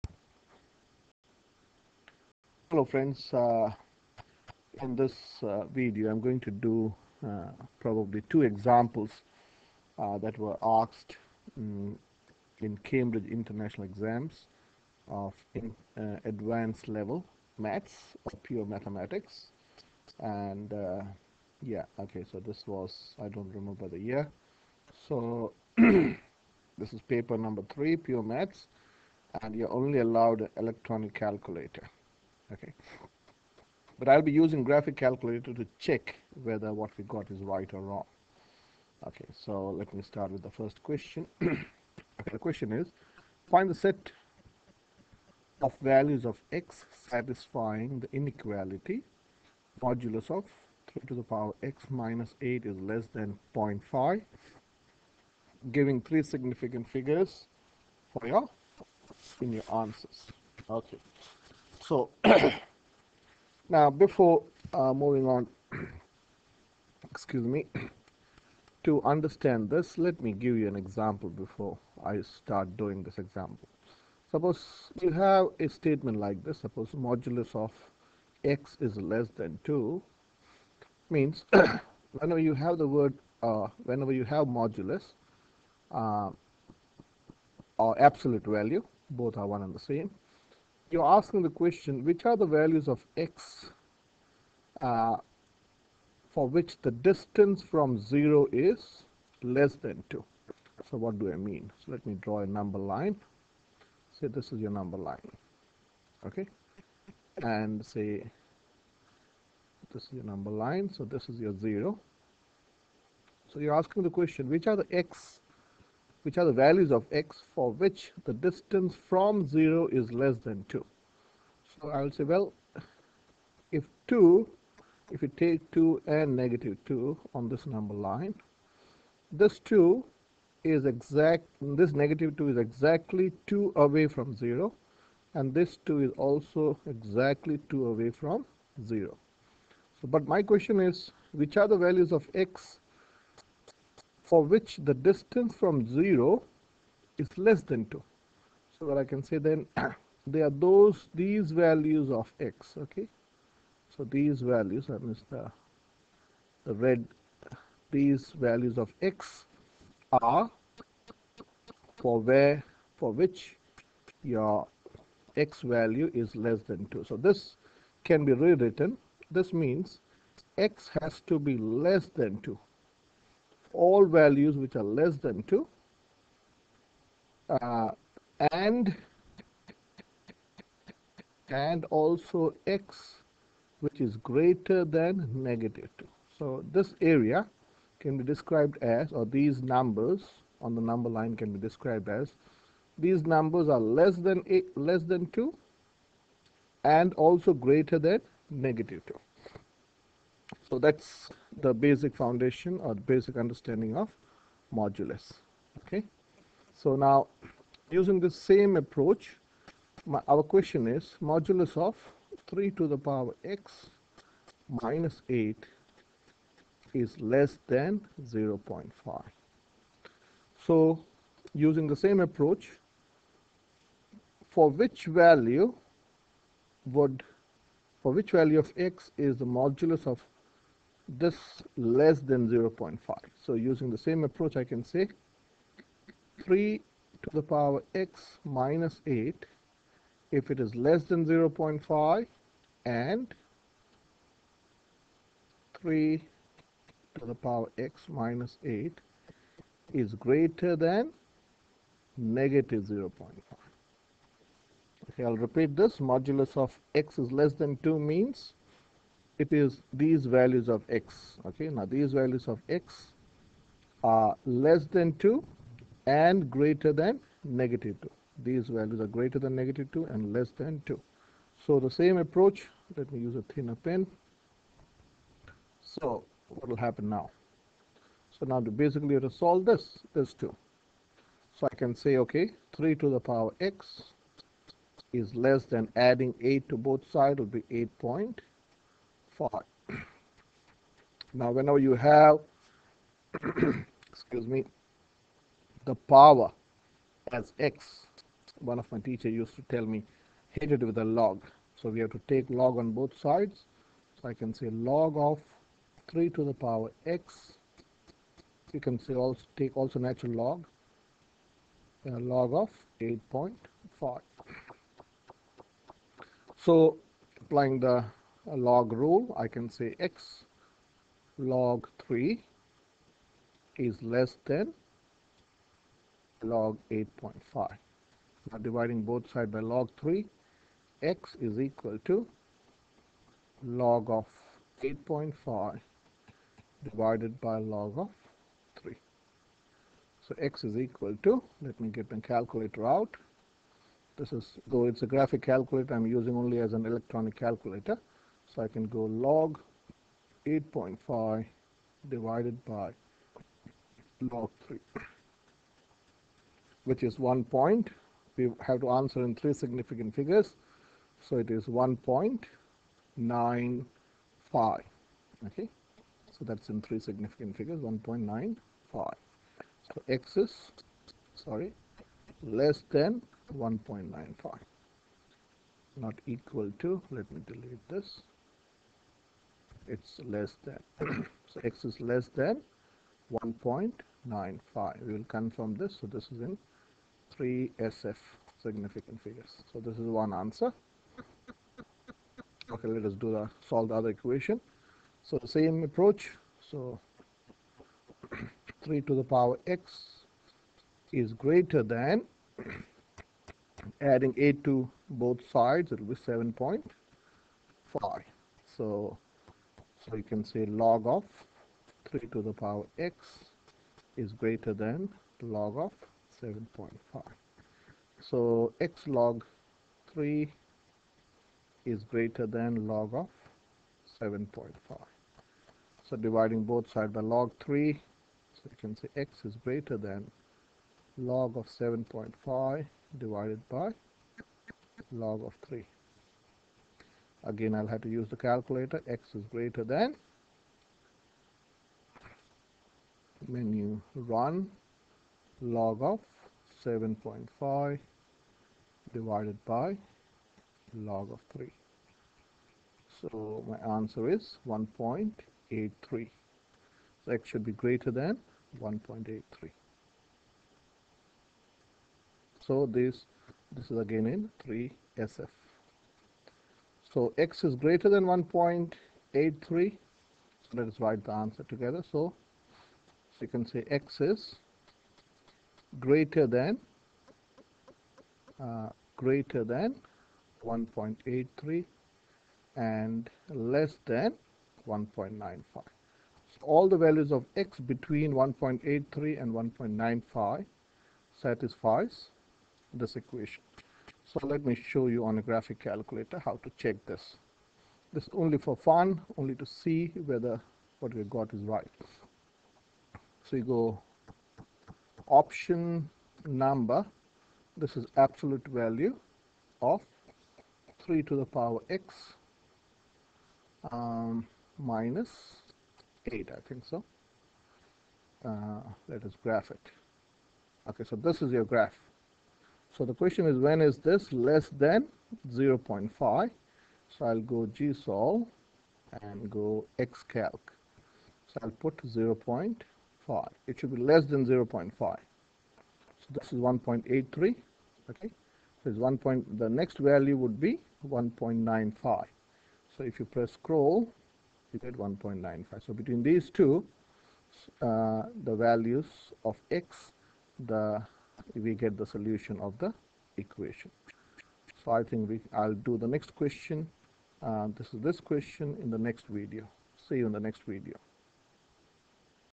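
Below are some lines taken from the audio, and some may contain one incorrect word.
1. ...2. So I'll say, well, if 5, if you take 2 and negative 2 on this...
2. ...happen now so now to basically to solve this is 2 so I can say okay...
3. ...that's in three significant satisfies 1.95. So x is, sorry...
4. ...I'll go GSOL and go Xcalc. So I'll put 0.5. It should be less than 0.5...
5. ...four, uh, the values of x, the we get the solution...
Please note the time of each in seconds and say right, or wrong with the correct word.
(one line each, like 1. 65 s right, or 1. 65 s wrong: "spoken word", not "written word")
1. 120 s wrong: "2", not "5"
2. 276 s right
3. 366 s wrong: "figures", not "satisfies"
4. 527 s right
5. 546 s wrong: "two", not "four".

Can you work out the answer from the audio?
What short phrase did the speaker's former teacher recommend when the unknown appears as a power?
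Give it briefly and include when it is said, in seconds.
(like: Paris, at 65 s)
hit it with a log, at 300 s.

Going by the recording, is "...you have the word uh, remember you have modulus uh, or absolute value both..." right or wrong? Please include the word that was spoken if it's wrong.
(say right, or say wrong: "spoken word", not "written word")
wrong: "whenever", not "remember".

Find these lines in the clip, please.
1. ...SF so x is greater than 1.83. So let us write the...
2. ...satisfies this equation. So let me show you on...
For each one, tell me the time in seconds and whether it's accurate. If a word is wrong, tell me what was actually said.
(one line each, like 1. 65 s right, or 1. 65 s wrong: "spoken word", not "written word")
1. 465 s right
2. 491 s right.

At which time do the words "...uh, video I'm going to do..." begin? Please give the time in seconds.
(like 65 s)
5 s.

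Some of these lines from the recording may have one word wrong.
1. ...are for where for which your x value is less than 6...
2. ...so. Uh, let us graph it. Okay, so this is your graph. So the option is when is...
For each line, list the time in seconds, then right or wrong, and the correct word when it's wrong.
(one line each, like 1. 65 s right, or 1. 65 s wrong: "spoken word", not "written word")
1. 160 s wrong: "2", not "6"
2. 516 s wrong: "question", not "option".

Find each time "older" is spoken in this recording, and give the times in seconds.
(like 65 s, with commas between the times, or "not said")
not said.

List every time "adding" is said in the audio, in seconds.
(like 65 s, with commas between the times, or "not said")
286 s, 404 s.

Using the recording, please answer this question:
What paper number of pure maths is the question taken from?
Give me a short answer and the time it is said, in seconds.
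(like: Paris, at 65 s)
3, at 27 s.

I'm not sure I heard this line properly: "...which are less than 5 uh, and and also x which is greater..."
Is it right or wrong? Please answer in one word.
wrong.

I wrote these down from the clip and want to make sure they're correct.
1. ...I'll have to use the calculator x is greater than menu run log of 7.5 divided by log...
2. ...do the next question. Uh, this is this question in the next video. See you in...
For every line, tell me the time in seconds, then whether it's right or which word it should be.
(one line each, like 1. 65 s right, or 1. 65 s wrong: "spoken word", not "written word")
1. 437 s right
2. 555 s right.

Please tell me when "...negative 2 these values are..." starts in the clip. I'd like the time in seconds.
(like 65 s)
267 s.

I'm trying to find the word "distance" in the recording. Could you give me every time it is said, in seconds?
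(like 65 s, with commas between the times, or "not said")
96 s, 118 s, 144 s.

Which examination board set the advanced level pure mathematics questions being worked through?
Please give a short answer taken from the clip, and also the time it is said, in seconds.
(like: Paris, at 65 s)
Cambridge International, at 12 s.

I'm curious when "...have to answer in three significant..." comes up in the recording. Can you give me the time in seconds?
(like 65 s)
358 s.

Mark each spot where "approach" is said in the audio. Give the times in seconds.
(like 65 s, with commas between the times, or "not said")
208 s, 222 s, 234 s, 272 s, 395 s.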